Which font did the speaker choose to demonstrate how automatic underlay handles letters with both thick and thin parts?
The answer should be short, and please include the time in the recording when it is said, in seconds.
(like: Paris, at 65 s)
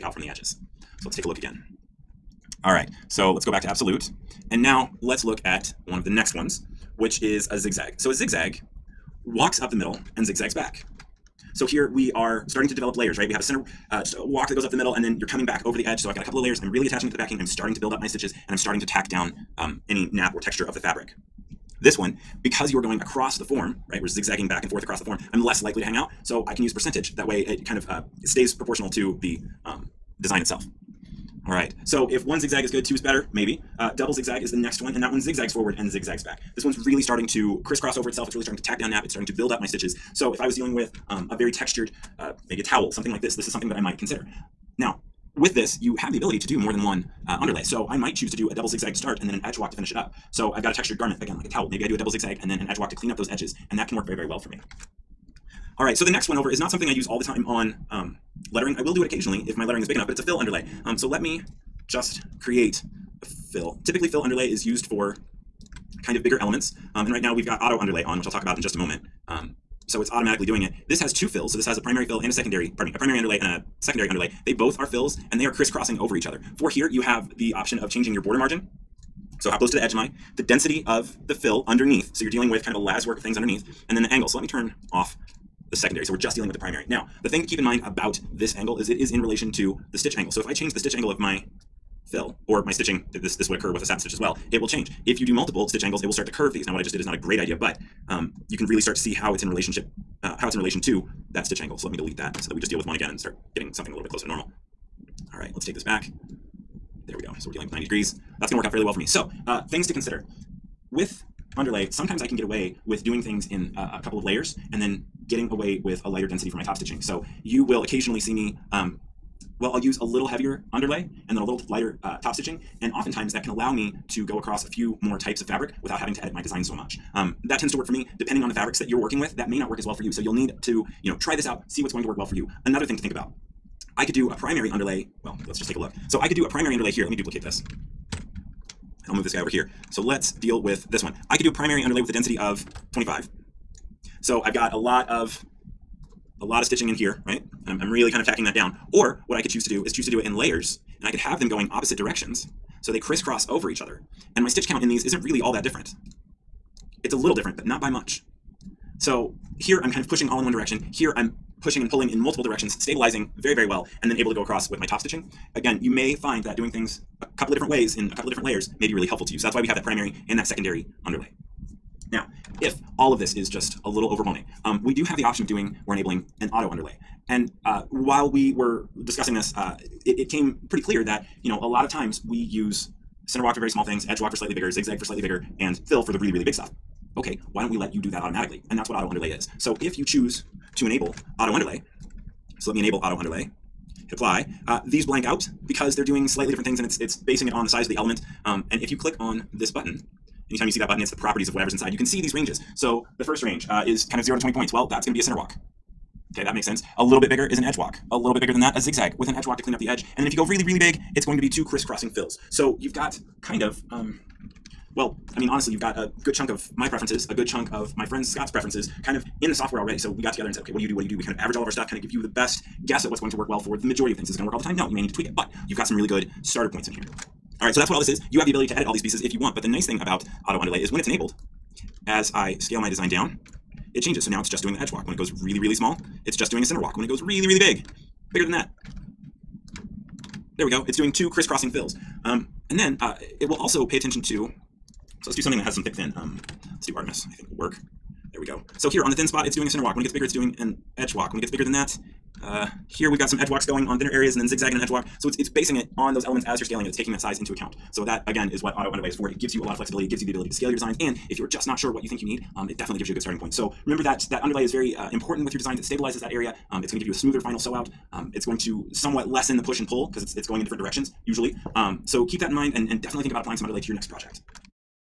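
Artemis, at 246 s.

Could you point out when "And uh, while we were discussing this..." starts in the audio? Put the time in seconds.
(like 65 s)
177 s.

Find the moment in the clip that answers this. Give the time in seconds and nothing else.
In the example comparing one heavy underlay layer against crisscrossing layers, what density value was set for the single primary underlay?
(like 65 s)
142 s.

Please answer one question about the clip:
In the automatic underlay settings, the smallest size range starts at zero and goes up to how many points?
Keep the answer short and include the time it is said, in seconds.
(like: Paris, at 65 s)
20, at 204 s.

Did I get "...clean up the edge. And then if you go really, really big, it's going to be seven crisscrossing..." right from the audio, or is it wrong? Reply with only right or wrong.
wrong.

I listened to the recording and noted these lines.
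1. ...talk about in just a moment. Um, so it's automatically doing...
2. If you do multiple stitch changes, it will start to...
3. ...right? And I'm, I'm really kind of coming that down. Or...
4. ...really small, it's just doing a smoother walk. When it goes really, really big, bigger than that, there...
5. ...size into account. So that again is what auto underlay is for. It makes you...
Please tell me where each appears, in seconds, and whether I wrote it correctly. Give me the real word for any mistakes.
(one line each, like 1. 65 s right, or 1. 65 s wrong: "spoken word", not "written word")
1. 68 s right
2. 95 s wrong: "angles", not "changes"
3. 147 s wrong: "tacking", not "coming"
4. 235 s wrong: "center", not "smoother"
5. 257 s wrong: "gives", not "makes".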